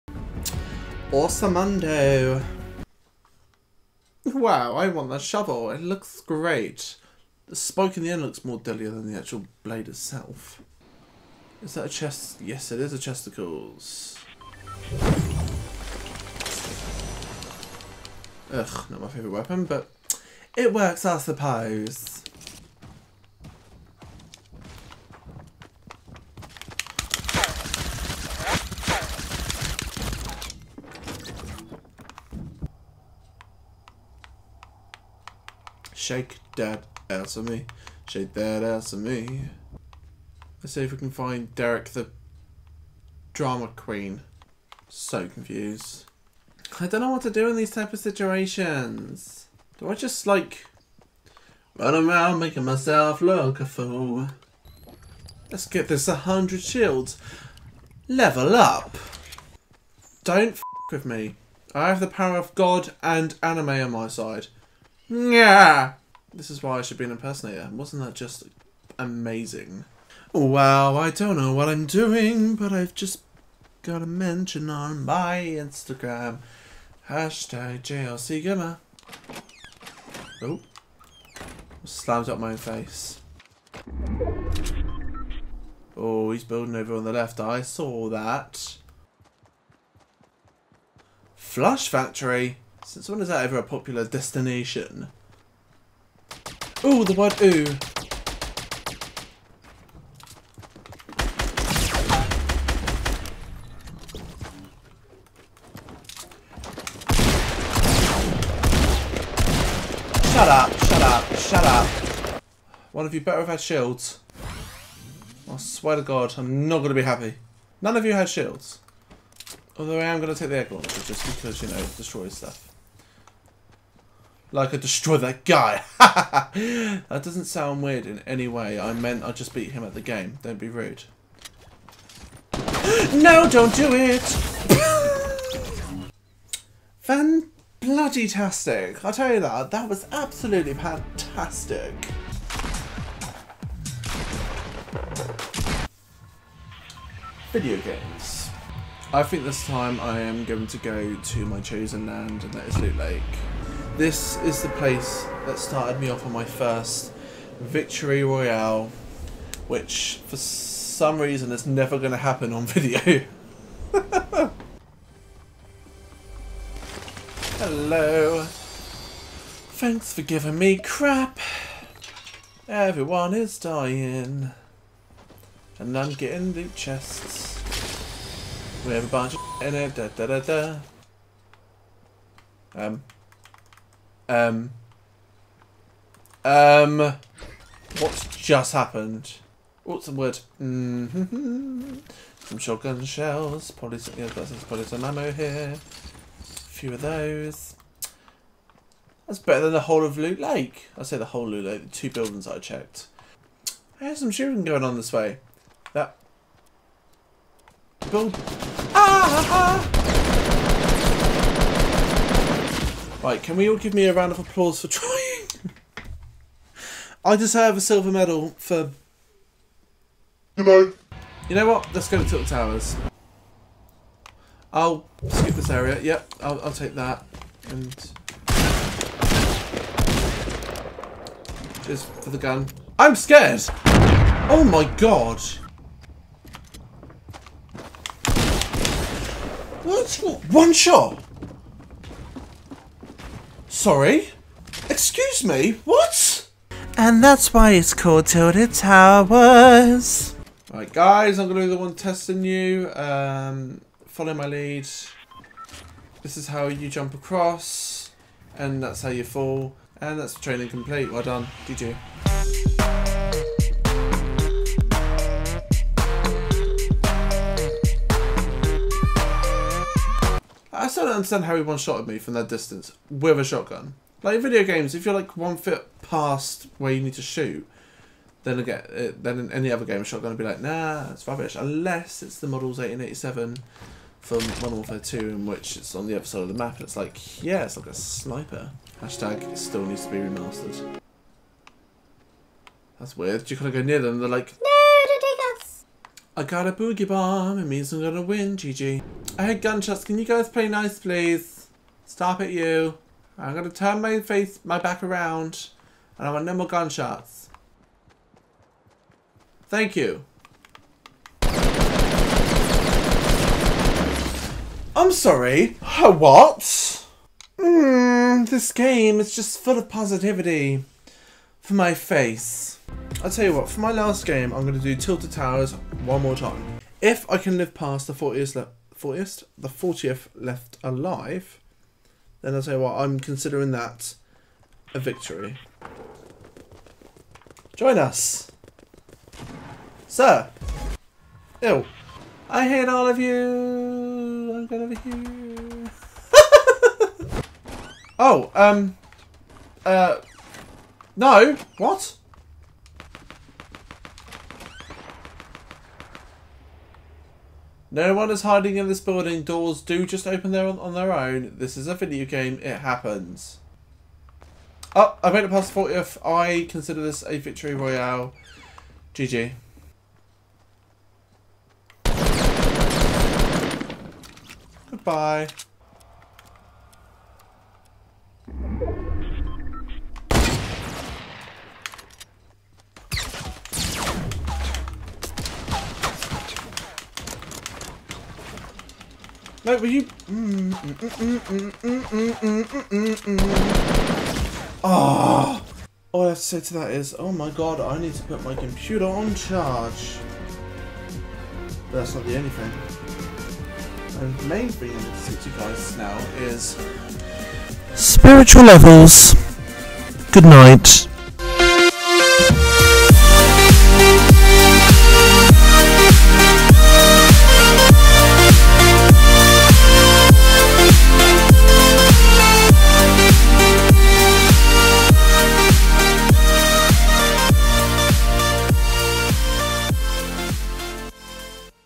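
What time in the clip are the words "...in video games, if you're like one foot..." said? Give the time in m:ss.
4:34.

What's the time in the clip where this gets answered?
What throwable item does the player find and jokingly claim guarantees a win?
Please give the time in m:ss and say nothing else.
4:56.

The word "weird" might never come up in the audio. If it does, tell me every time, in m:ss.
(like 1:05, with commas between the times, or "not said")
2:07, 4:53.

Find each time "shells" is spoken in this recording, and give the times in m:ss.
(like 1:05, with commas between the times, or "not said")
3:13.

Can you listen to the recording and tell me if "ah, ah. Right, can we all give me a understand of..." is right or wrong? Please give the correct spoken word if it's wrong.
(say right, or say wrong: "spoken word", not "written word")
wrong: "round", not "understand".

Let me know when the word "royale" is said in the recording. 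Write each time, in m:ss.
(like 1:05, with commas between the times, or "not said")
2:38, 6:07.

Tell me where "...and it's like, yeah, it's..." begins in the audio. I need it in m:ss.
4:46.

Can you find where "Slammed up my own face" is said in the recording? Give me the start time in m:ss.
1:21.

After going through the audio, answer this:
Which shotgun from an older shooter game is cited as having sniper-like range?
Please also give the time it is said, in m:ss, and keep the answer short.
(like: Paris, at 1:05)
Model 1887, at 4:42.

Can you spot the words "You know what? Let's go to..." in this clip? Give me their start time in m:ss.
3:41.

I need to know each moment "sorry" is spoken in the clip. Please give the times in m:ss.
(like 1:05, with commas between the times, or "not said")
4:03, 5:15.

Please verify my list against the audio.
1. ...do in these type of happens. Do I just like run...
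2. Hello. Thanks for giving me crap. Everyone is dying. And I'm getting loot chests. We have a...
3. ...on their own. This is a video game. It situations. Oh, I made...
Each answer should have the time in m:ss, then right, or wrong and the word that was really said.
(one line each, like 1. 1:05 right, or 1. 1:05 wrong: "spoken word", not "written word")
1. 0:47 wrong: "situations", not "happens"
2. 2:47 right
3. 6:00 wrong: "happens", not "situations".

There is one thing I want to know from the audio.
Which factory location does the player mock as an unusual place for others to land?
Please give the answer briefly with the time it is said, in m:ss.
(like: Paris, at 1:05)
Flush Factory, at 1:31.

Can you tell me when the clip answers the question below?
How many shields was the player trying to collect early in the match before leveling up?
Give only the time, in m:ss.
0:56.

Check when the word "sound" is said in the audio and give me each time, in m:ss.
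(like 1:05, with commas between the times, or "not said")
2:07.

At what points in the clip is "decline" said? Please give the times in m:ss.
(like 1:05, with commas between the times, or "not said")
not said.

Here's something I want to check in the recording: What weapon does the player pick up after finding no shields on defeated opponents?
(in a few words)
Egg launcher.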